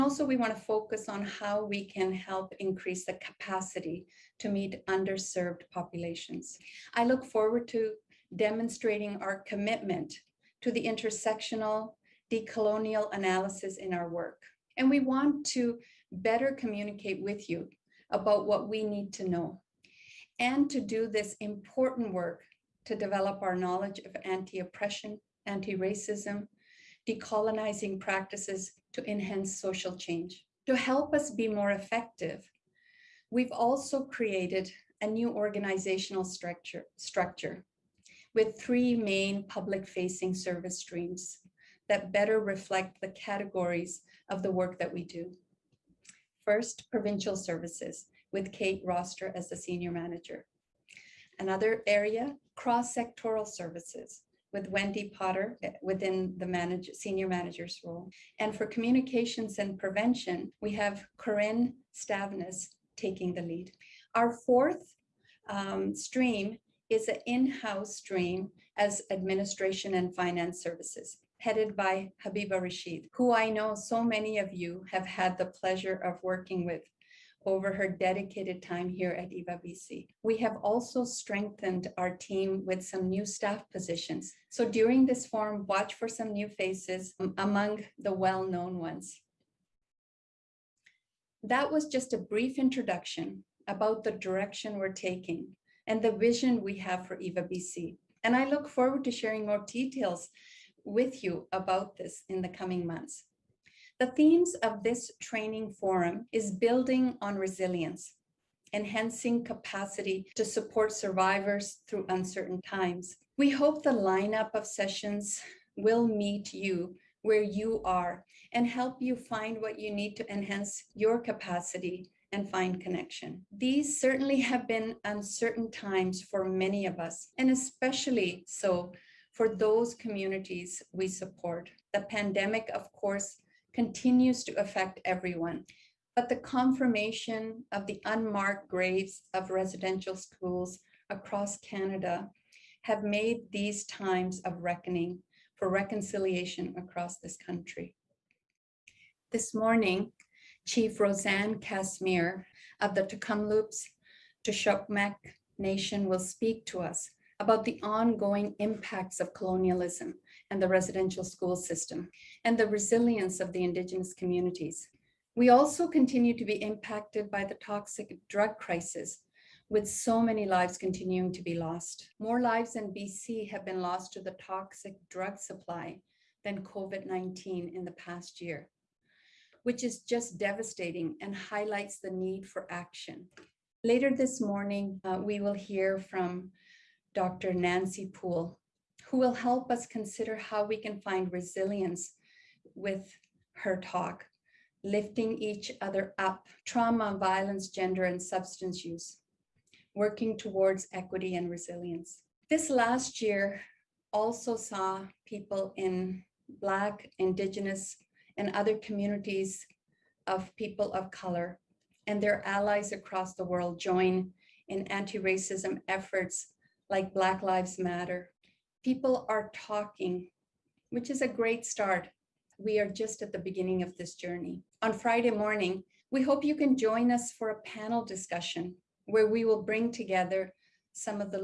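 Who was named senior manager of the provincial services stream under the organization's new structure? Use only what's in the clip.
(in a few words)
Kate Rossiter.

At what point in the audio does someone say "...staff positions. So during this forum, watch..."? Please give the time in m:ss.
1:23.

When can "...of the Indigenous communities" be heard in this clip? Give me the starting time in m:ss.
2:43.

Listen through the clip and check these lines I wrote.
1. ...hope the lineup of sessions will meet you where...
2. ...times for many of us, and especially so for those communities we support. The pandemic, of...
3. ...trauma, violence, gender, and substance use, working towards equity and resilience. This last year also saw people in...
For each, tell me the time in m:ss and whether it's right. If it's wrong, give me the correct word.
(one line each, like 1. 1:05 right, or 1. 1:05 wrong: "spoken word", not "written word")
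1. 1:53 right
2. 2:05 right
3. 3:16 right.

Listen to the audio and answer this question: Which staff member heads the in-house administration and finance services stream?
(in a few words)
Habiba Rashid.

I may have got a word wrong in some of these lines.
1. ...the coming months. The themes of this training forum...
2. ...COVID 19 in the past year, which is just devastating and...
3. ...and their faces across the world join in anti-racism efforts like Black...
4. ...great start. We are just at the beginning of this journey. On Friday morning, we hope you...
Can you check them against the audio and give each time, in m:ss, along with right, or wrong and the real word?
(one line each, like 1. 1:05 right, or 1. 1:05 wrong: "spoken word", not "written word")
1. 1:42 right
2. 2:56 right
3. 3:32 wrong: "allies", not "faces"
4. 3:41 right.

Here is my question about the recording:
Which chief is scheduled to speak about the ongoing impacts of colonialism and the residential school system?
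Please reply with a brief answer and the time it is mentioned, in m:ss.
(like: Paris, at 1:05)
Rosanne Casimir, at 2:30.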